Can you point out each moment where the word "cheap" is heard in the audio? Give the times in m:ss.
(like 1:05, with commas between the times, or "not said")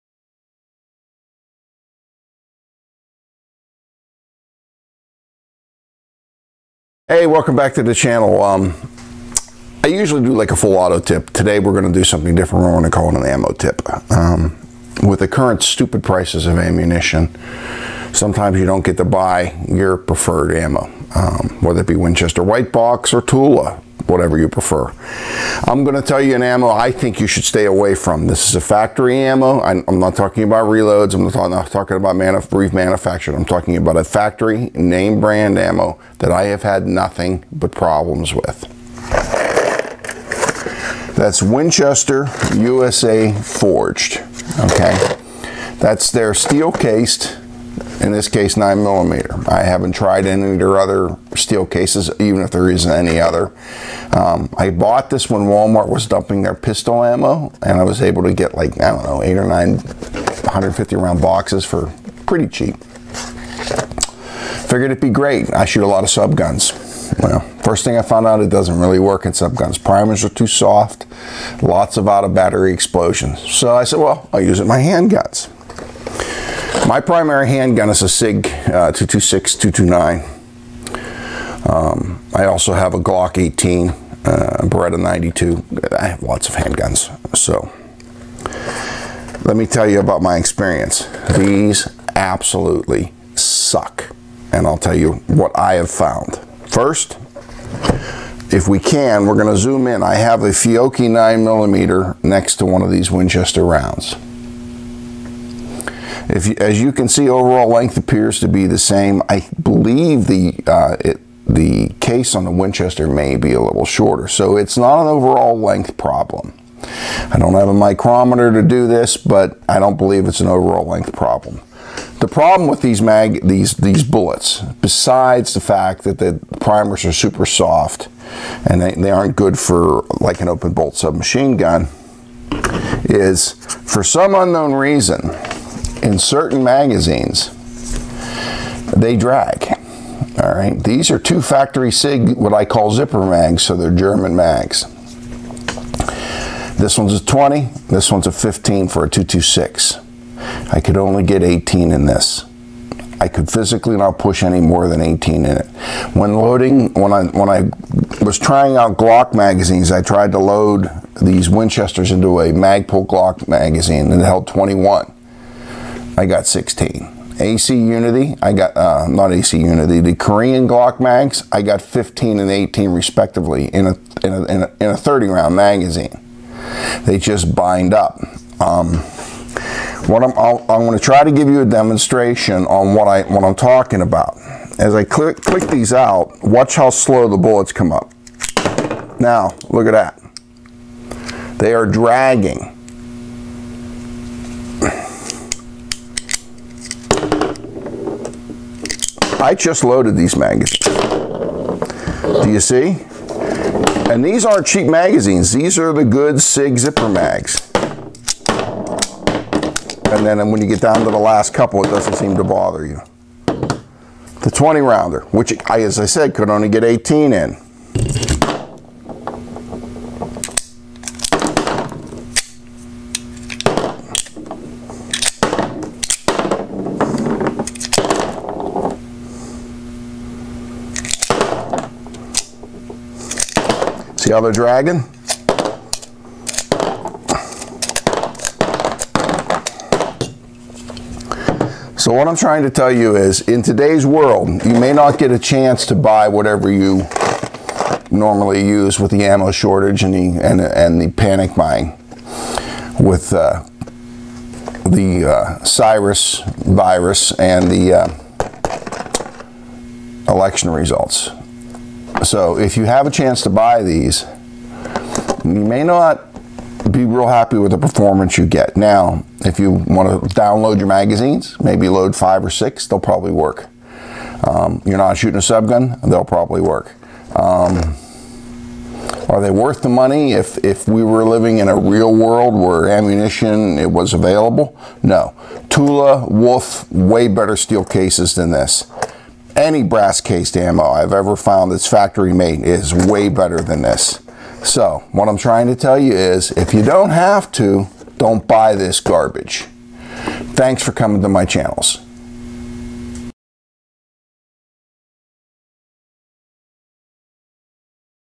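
1:02, 3:24.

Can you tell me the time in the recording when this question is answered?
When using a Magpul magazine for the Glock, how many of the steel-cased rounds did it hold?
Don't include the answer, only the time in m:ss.
2:44.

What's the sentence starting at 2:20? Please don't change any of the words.
All right, these are two factory SIG, what I call zipper mags, so they're German mags.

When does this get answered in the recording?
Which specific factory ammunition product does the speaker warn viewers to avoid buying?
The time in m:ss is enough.
0:41.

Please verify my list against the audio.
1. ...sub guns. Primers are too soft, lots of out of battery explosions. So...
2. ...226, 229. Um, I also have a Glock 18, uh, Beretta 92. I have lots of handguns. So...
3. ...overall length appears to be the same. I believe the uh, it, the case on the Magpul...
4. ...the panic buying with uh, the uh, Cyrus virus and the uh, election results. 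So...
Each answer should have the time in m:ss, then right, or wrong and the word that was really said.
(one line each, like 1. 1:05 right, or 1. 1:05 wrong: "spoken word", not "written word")
1. 1:09 right
2. 1:18 right
3. 1:47 wrong: "Winchester", not "Magpul"
4. 4:11 right.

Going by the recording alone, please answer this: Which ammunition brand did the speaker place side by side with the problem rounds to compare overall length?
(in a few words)
Fiocchi.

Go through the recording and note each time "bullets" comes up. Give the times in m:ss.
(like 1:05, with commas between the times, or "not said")
2:04, 3:07.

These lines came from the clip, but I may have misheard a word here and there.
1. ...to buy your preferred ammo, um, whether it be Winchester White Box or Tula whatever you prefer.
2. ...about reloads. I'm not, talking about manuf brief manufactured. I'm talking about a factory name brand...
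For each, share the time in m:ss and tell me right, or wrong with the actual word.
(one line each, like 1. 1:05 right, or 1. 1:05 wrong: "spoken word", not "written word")
1. 0:18 right
2. 0:30 right.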